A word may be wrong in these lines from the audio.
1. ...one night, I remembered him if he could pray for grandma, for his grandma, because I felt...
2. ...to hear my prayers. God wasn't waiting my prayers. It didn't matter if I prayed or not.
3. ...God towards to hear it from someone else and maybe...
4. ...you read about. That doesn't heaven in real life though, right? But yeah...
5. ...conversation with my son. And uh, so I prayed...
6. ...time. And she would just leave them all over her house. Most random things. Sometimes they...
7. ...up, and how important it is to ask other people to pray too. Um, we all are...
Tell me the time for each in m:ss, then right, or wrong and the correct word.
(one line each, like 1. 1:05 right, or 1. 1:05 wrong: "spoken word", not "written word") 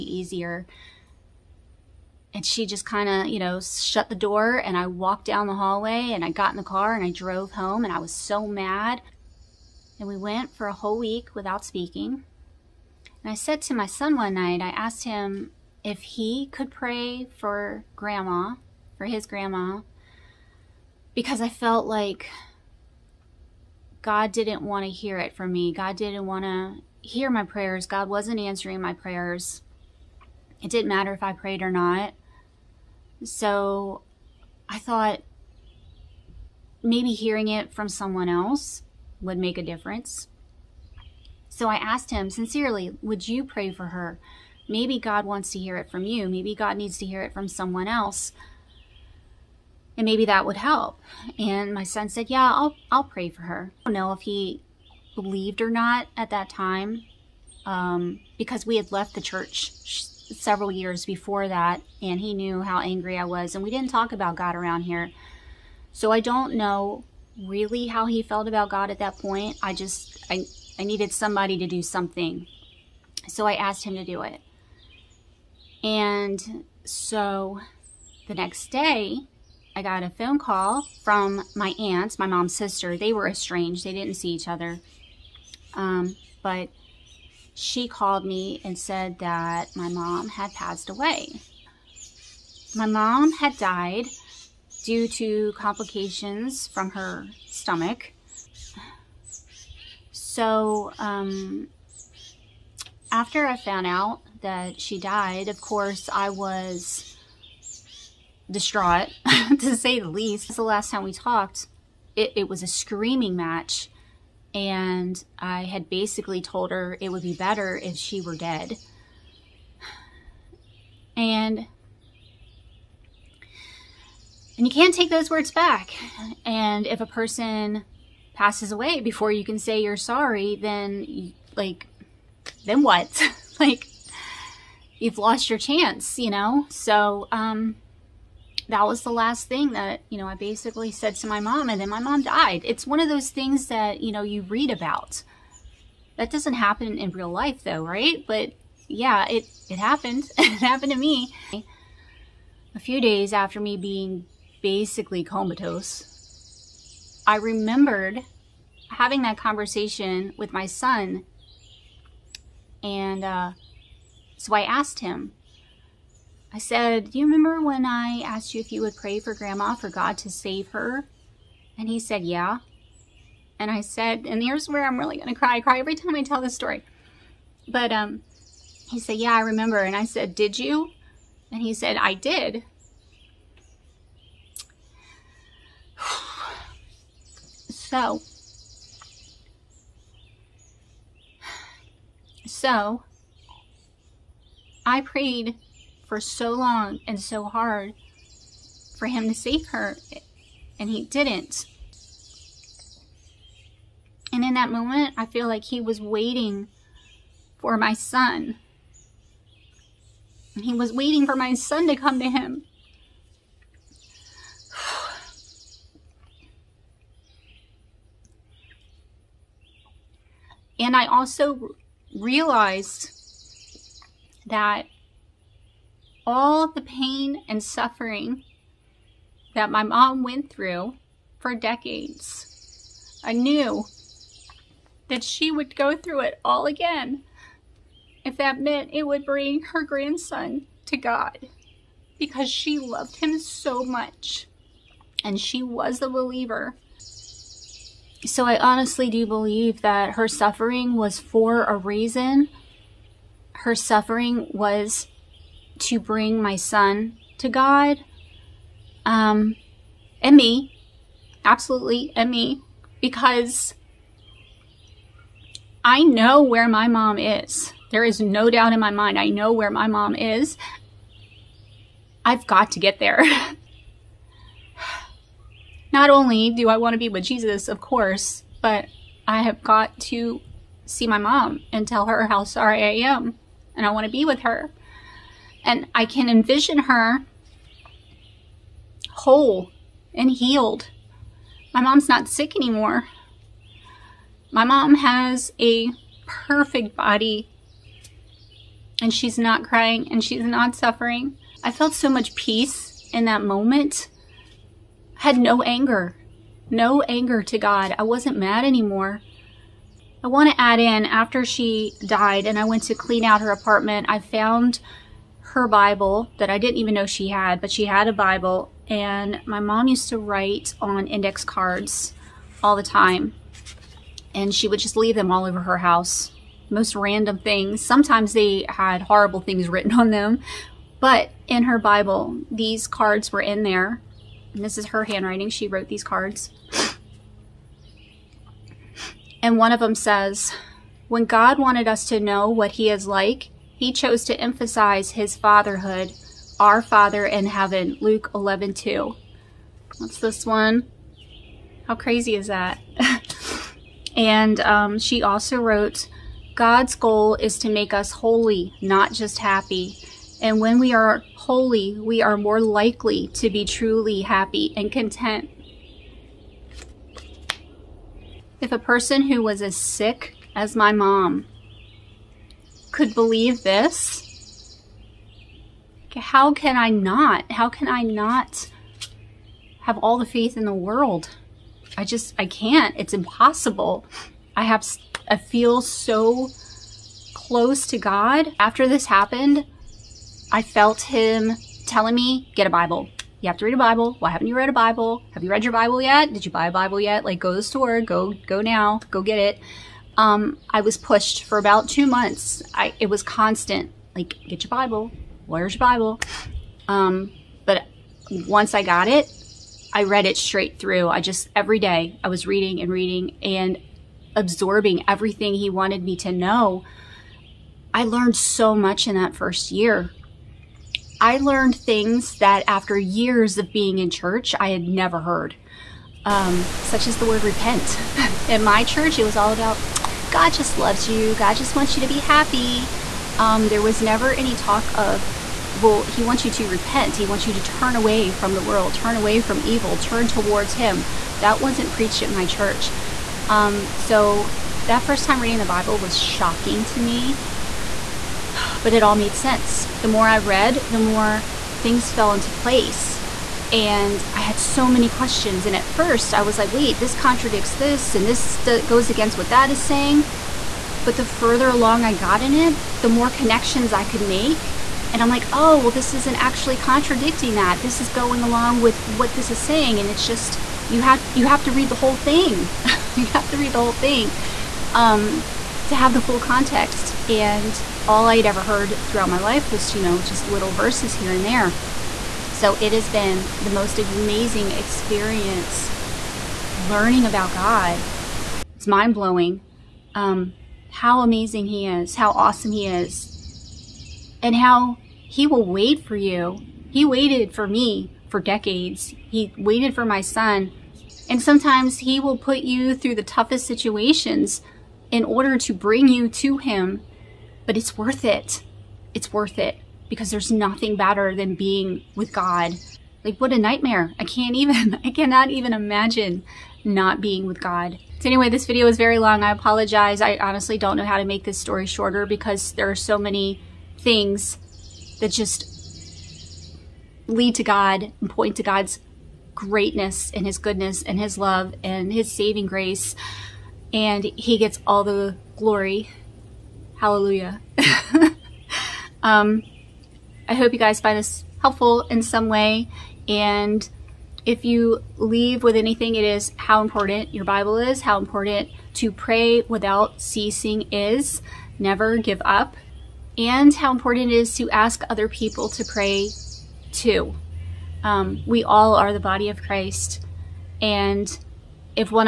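1. 0:14 wrong: "asked", not "remembered"
2. 0:26 wrong: "answering", not "waiting"
3. 0:46 wrong: "needs", not "towards"
4. 2:24 wrong: "happen", not "heaven"
5. 2:39 wrong: "asked", not "prayed"
6. 5:22 right
7. 9:12 right.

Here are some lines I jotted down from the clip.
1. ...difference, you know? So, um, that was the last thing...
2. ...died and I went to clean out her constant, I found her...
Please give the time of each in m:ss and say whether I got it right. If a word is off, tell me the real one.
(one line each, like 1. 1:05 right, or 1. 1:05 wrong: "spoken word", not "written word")
1. 2:15 wrong: "chance", not "difference"
2. 5:12 wrong: "apartment", not "constant".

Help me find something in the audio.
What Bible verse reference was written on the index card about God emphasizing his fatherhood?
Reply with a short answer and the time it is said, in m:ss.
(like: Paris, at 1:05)
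Luke 11:2, at 5:47.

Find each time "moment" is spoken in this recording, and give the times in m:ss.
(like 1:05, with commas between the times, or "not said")
3:24, 5:03.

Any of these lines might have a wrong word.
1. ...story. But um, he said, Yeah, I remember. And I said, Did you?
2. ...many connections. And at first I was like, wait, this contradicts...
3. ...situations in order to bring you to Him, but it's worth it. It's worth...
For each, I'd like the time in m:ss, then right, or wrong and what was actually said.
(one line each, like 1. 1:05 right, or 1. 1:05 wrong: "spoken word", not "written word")
1. 2:56 right
2. 7:34 wrong: "questions", not "connections"
3. 8:23 right.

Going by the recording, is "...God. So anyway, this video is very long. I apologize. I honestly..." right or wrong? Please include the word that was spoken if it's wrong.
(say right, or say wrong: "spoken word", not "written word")
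right.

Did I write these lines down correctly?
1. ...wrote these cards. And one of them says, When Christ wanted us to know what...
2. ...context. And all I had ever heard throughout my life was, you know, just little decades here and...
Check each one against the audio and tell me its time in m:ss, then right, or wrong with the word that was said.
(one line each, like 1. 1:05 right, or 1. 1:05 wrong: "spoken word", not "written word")
1. 5:35 wrong: "God", not "Christ"
2. 7:56 wrong: "verses", not "decades".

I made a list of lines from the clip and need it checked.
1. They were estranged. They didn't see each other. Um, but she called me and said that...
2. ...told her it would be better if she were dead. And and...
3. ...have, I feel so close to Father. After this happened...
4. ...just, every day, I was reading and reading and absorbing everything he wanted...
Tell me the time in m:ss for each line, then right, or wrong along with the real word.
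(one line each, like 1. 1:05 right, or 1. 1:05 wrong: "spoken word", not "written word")
1. 1:22 right
2. 1:56 right
3. 6:24 wrong: "God", not "Father"
4. 6:51 right.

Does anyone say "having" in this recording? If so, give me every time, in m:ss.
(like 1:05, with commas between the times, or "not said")
2:38.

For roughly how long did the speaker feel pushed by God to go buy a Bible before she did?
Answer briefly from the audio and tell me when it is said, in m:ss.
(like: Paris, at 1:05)
About 2 months, at 6:41.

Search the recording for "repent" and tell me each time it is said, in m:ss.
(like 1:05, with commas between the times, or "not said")
7:07, 7:16.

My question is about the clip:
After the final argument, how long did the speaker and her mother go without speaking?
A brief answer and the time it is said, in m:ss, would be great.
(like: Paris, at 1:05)
A whole week, at 0:10.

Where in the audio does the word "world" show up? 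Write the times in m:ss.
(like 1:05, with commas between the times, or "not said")
6:20, 7:18.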